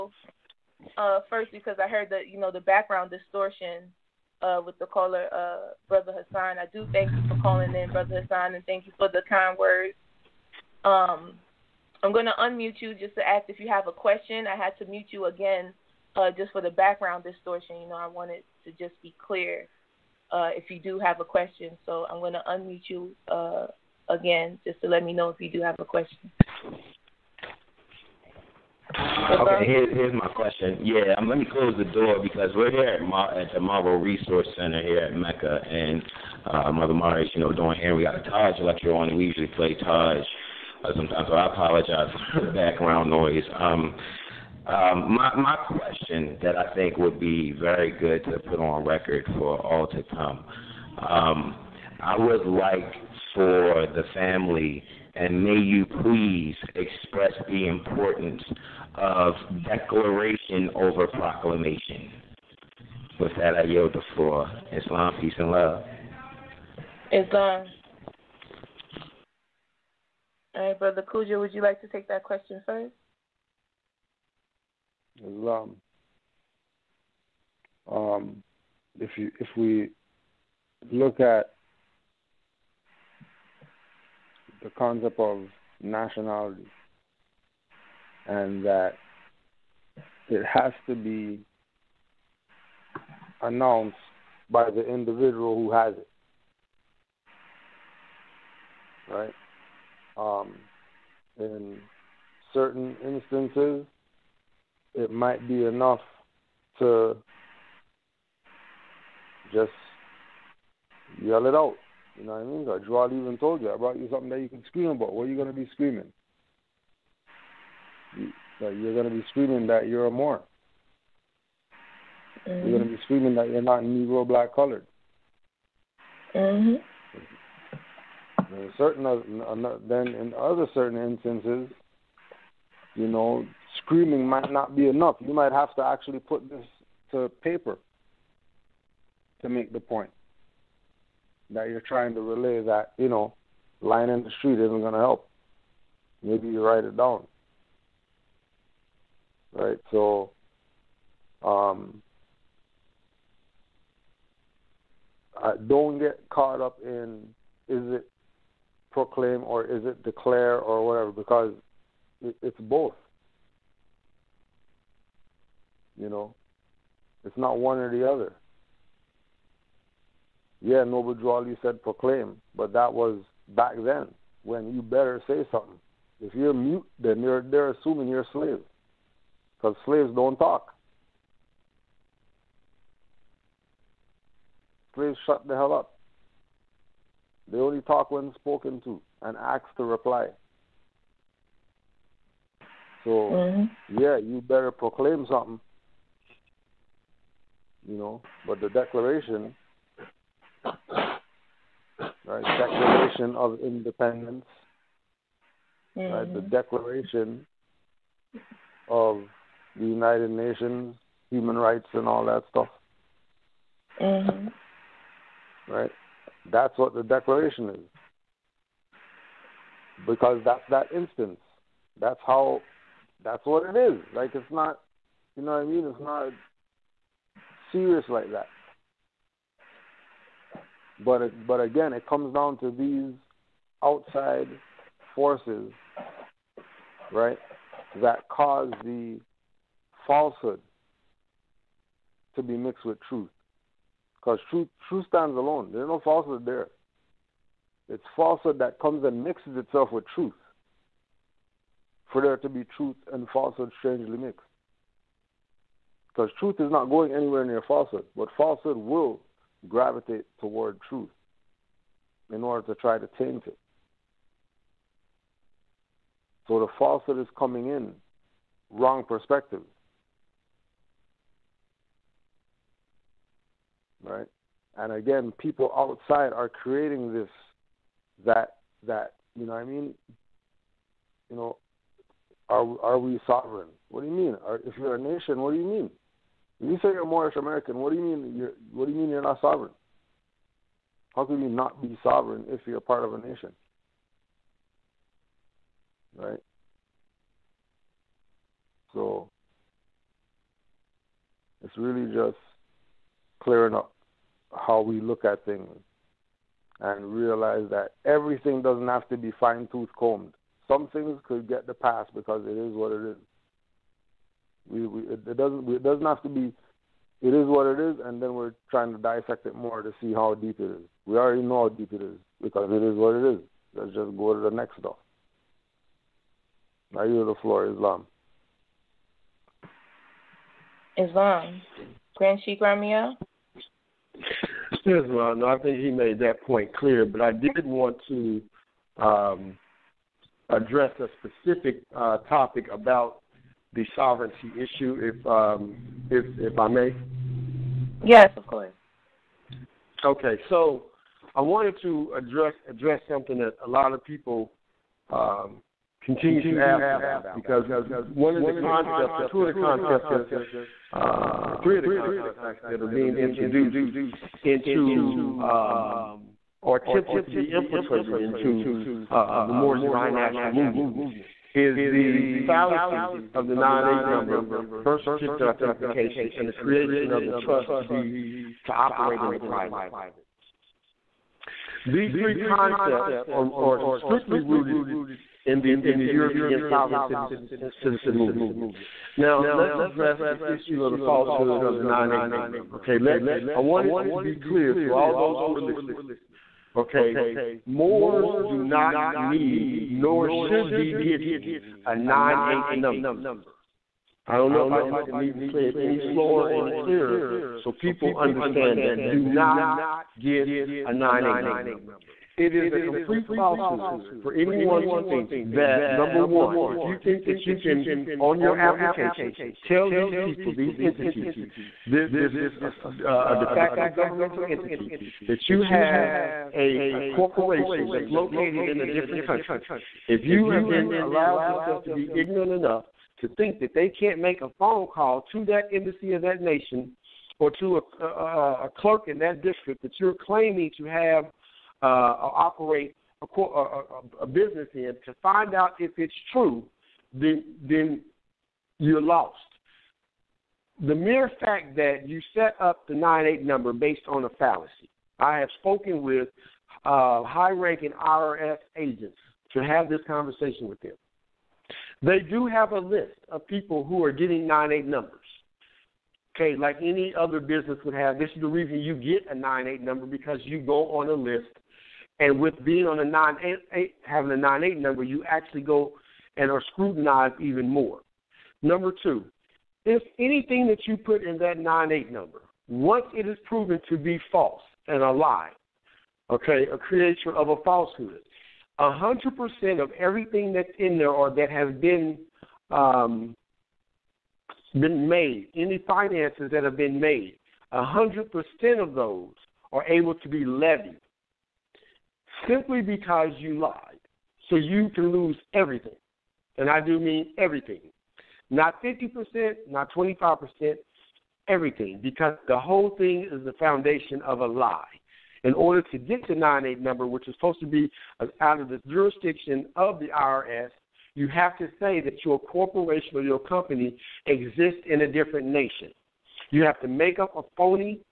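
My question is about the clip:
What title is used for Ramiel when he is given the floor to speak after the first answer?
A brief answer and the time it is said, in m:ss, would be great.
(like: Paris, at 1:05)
Grand Sheikh, at 5:32.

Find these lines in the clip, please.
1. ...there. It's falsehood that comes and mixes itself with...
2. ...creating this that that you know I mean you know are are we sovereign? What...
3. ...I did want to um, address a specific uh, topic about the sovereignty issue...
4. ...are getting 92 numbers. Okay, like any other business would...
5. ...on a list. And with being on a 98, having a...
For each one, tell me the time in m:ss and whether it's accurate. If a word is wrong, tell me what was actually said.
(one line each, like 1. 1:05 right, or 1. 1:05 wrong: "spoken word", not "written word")
1. 4:06 right
2. 4:36 right
3. 5:37 right
4. 7:44 wrong: "98", not "92"
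5. 7:50 right.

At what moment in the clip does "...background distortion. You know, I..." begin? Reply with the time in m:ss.
0:16.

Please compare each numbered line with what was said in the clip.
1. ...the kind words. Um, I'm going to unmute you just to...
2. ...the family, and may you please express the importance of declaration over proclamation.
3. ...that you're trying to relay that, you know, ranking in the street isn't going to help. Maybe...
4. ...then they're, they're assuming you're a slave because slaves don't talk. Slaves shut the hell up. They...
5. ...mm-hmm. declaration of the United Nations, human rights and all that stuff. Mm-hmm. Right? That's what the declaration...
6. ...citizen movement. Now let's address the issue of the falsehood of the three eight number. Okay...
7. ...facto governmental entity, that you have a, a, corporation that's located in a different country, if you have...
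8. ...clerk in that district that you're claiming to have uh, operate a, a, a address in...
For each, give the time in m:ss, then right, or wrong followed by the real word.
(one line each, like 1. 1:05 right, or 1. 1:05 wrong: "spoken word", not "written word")
1. 0:09 right
2. 0:53 right
3. 2:21 wrong: "lying", not "ranking"
4. 2:56 right
5. 3:26 right
6. 6:27 wrong: "nine", not "three"
7. 7:03 right
8. 7:18 wrong: "business", not "address".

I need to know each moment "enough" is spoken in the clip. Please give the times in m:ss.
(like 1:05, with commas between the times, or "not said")
1:45, 2:14, 7:12.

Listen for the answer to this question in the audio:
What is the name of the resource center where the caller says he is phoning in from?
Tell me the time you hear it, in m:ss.
0:33.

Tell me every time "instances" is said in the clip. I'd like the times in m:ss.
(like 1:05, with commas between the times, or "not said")
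1:43, 2:10, 3:40.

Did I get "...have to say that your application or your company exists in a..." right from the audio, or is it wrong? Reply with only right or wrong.
wrong.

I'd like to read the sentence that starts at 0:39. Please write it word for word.
We usually play Taj uh, sometimes.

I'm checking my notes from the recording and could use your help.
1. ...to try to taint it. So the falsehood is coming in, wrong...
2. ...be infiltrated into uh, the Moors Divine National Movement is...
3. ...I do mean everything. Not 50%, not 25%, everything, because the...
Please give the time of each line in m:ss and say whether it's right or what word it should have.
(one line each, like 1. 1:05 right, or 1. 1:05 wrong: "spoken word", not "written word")
1. 4:22 right
2. 6:07 right
3. 8:26 right.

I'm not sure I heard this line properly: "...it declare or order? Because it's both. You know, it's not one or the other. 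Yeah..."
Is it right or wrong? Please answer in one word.
wrong.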